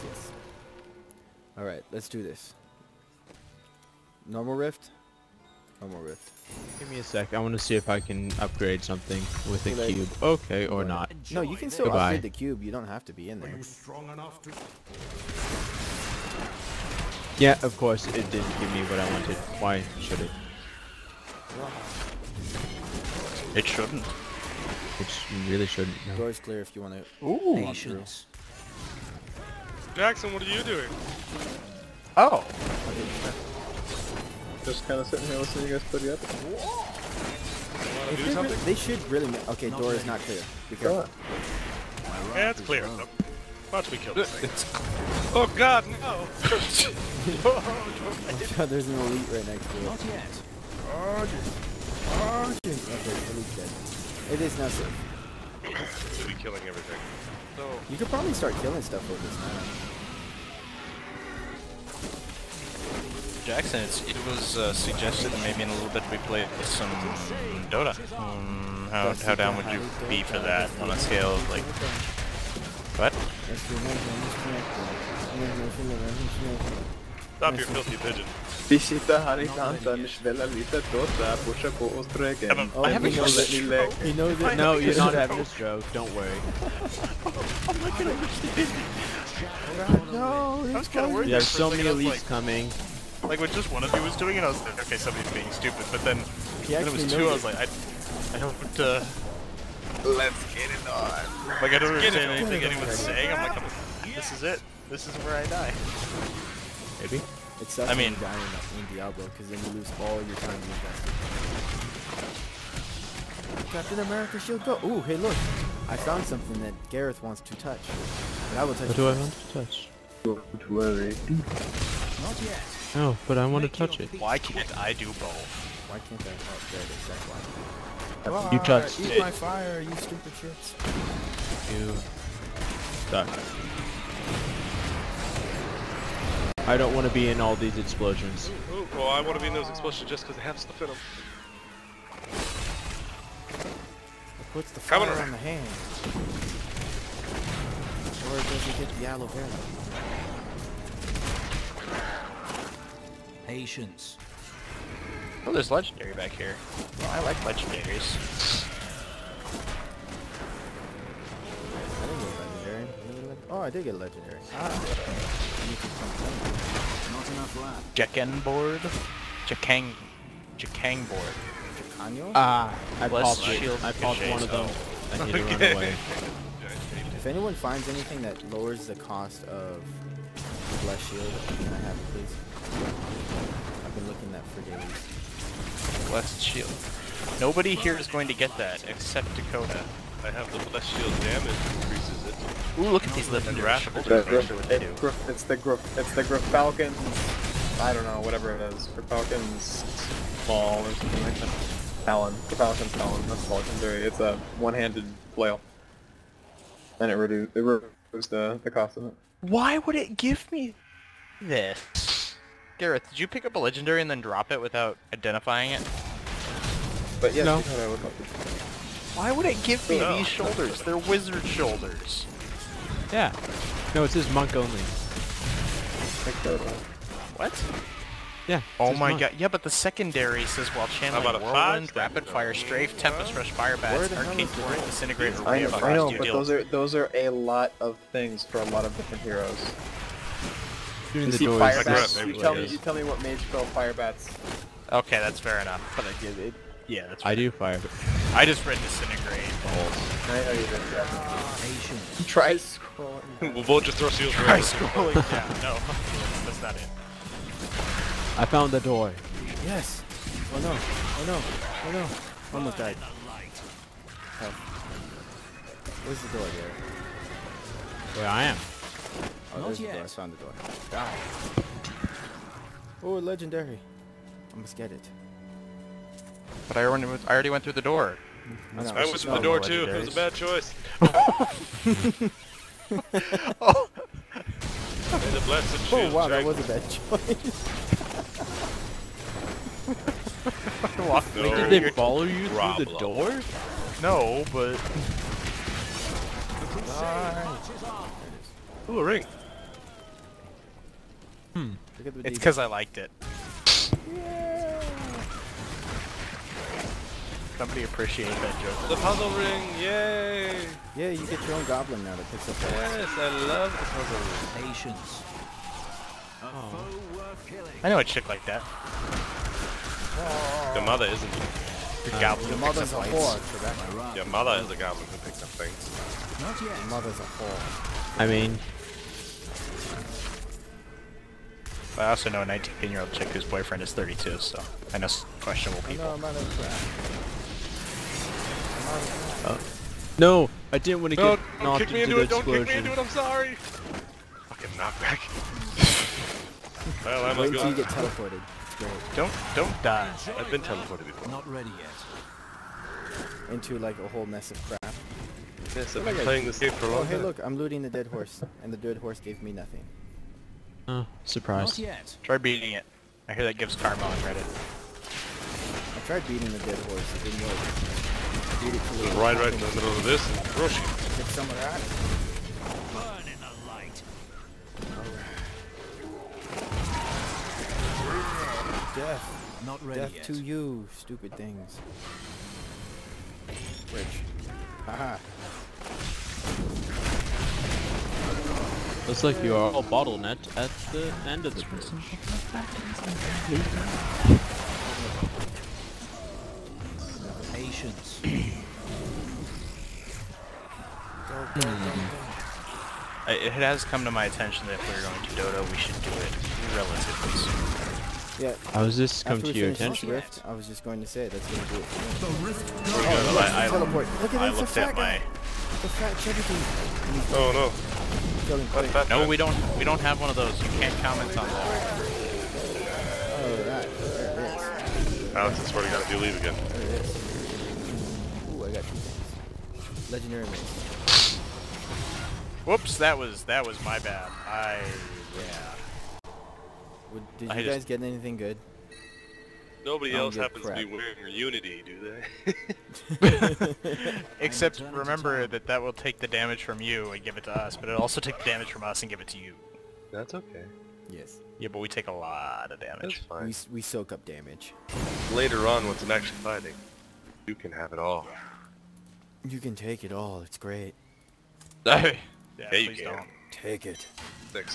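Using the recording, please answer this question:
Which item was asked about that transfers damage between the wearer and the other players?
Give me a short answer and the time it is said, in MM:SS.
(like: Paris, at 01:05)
Unity, at 07:21.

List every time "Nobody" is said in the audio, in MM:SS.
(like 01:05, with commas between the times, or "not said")
03:07, 07:19.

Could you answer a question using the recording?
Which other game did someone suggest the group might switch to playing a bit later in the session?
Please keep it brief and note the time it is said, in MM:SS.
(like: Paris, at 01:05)
Dota, at 01:07.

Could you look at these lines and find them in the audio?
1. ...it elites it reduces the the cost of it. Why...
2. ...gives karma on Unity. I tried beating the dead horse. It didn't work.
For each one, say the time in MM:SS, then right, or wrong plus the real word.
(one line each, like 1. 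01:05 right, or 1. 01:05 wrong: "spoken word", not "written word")
1. 03:27 wrong: "reduces", not "elites"
2. 06:03 wrong: "Reddit", not "Unity".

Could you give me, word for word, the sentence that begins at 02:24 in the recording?
It puts the fire Coming around.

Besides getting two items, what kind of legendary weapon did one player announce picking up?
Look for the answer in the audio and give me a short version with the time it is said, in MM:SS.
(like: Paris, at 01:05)
Mace, at 07:10.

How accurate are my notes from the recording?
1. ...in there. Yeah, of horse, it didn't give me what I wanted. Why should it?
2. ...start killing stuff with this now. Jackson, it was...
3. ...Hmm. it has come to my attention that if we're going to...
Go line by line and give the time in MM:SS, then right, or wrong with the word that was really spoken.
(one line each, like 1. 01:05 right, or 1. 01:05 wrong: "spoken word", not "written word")
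1. 00:13 wrong: "course", not "horse"
2. 00:58 right
3. 06:41 right.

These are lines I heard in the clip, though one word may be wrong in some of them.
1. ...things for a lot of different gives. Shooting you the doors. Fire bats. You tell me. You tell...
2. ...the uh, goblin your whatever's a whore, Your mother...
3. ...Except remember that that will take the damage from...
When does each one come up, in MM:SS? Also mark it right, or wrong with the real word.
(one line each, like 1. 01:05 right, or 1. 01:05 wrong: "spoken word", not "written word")
1. 03:58 wrong: "heroes", not "gives"
2. 05:22 wrong: "mother", not "whatever"
3. 07:24 right.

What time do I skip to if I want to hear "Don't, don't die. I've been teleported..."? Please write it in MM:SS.
05:49.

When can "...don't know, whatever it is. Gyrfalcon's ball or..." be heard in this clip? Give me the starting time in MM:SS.
03:17.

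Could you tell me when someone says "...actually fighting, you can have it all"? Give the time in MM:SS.
07:36.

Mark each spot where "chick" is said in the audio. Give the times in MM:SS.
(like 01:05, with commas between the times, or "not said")
05:18, 05:33.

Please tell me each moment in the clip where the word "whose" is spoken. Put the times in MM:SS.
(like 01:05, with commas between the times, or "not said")
05:33.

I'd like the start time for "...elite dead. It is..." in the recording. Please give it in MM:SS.
00:53.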